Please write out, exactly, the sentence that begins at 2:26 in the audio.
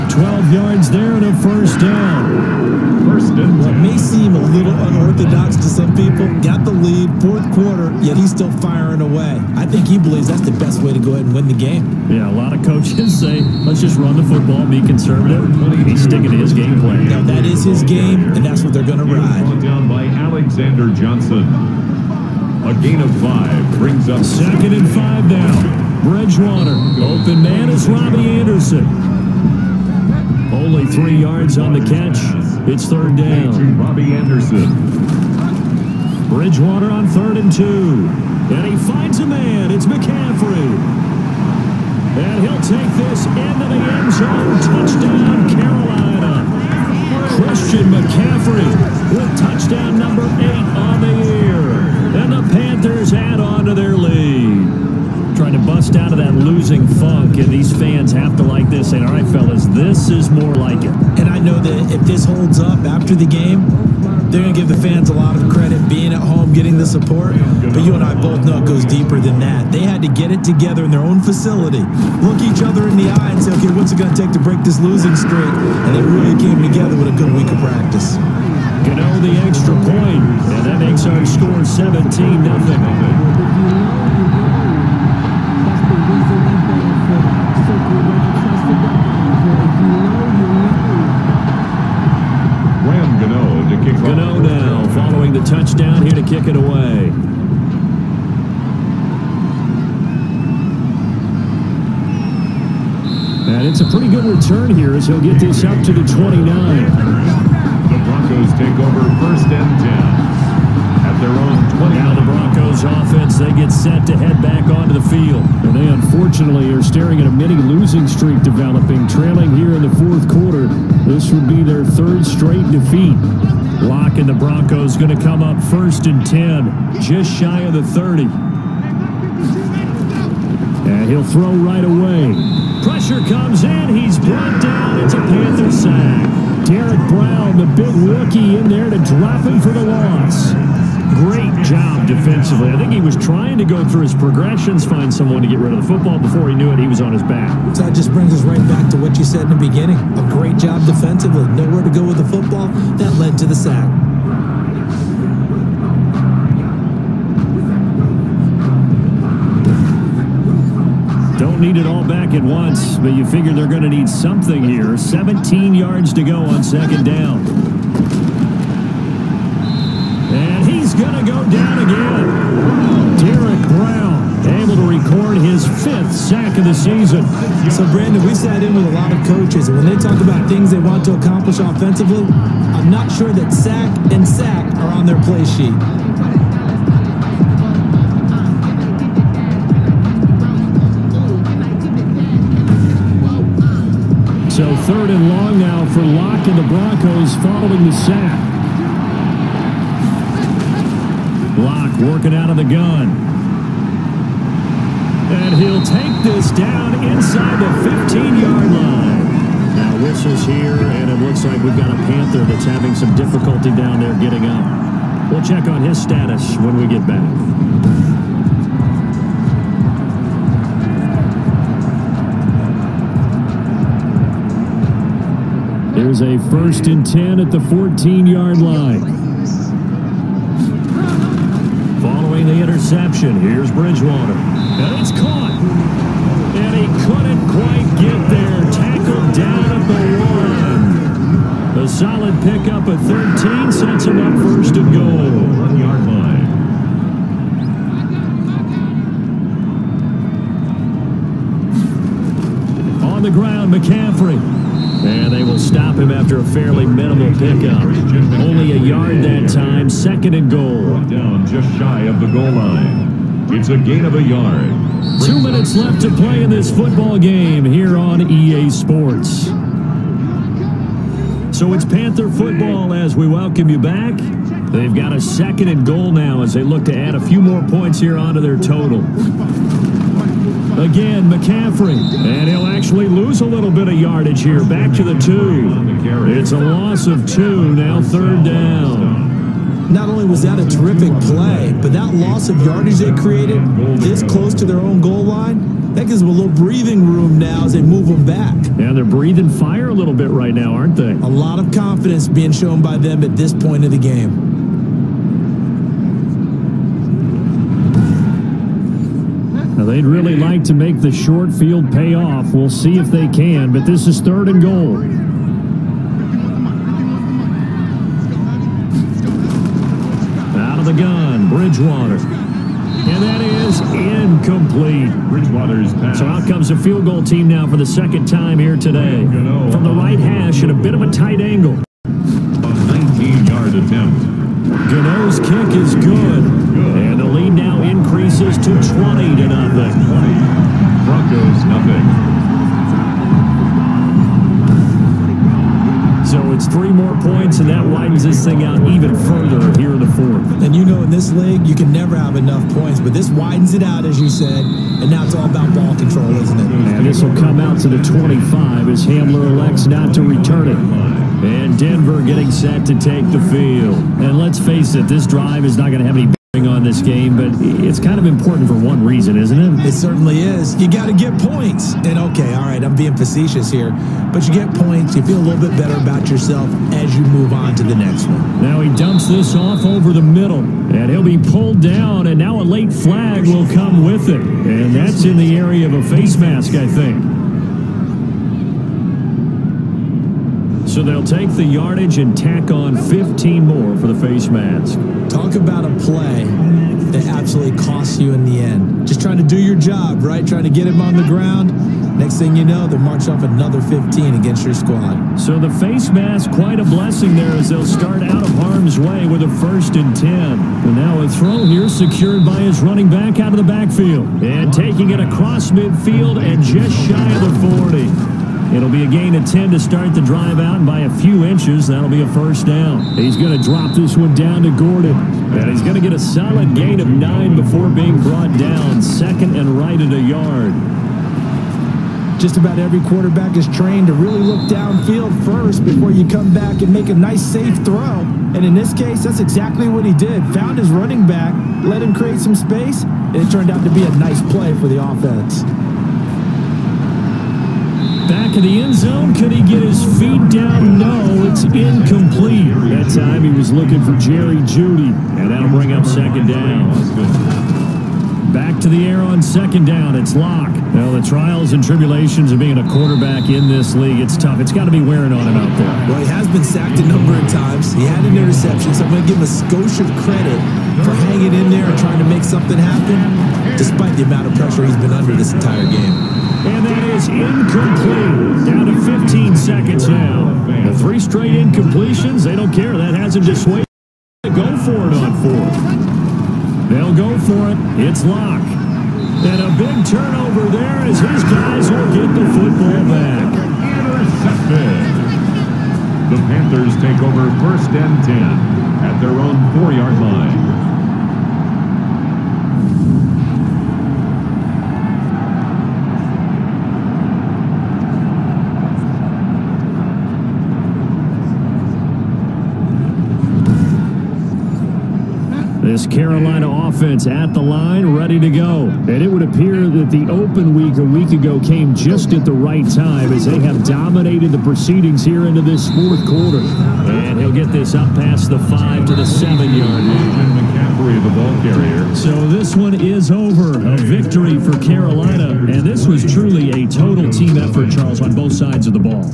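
Before he knew it, he was on his back.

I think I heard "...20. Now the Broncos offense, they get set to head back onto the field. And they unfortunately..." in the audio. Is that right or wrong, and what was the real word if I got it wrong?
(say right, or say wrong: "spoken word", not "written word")
right.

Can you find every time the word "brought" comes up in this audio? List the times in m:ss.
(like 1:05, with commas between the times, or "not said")
2:14, 7:08.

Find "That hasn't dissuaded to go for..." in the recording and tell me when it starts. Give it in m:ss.
8:02.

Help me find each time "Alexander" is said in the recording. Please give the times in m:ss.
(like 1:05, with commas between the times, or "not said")
0:20.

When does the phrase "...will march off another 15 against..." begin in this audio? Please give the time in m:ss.
6:42.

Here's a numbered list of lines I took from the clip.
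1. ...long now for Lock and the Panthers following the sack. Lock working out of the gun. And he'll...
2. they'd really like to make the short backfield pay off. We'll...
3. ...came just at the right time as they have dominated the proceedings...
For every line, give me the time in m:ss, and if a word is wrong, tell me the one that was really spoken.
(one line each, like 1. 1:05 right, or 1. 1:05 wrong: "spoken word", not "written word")
1. 3:15 wrong: "Broncos", not "Panthers"
2. 5:09 wrong: "field", not "backfield"
3. 8:41 right.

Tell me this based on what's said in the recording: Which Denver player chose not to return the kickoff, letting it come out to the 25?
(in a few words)
Hamler.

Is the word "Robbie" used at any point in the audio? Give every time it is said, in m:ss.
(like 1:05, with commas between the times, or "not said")
0:27, 0:33.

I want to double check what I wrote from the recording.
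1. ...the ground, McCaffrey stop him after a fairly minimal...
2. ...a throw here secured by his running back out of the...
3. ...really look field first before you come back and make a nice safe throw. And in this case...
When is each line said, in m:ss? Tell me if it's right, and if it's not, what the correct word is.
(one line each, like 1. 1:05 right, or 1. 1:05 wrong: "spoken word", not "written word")
1. 4:13 right
2. 6:51 right
3. 7:14 wrong: "downfield", not "field".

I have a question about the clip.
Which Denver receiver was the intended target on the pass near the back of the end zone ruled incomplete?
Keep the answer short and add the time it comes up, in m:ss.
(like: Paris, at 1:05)
Jerry Jeudy, at 7:34.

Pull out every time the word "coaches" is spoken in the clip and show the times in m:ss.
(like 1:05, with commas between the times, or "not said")
0:12, 2:59.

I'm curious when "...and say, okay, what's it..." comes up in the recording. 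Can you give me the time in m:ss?
1:13.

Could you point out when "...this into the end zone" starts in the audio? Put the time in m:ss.
0:42.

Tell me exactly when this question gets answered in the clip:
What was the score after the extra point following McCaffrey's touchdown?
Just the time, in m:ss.
1:21.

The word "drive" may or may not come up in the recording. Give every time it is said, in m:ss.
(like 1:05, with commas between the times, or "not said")
6:05, 7:00.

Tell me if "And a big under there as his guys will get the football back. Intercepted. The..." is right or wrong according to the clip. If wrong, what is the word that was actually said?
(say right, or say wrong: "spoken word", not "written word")
wrong: "turnover", not "under".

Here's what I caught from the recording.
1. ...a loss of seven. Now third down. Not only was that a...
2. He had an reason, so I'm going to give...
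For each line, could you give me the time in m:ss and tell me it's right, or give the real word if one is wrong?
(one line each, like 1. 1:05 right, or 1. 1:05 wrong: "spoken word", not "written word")
1. 4:46 wrong: "two", not "seven"
2. 7:47 wrong: "interception", not "reason".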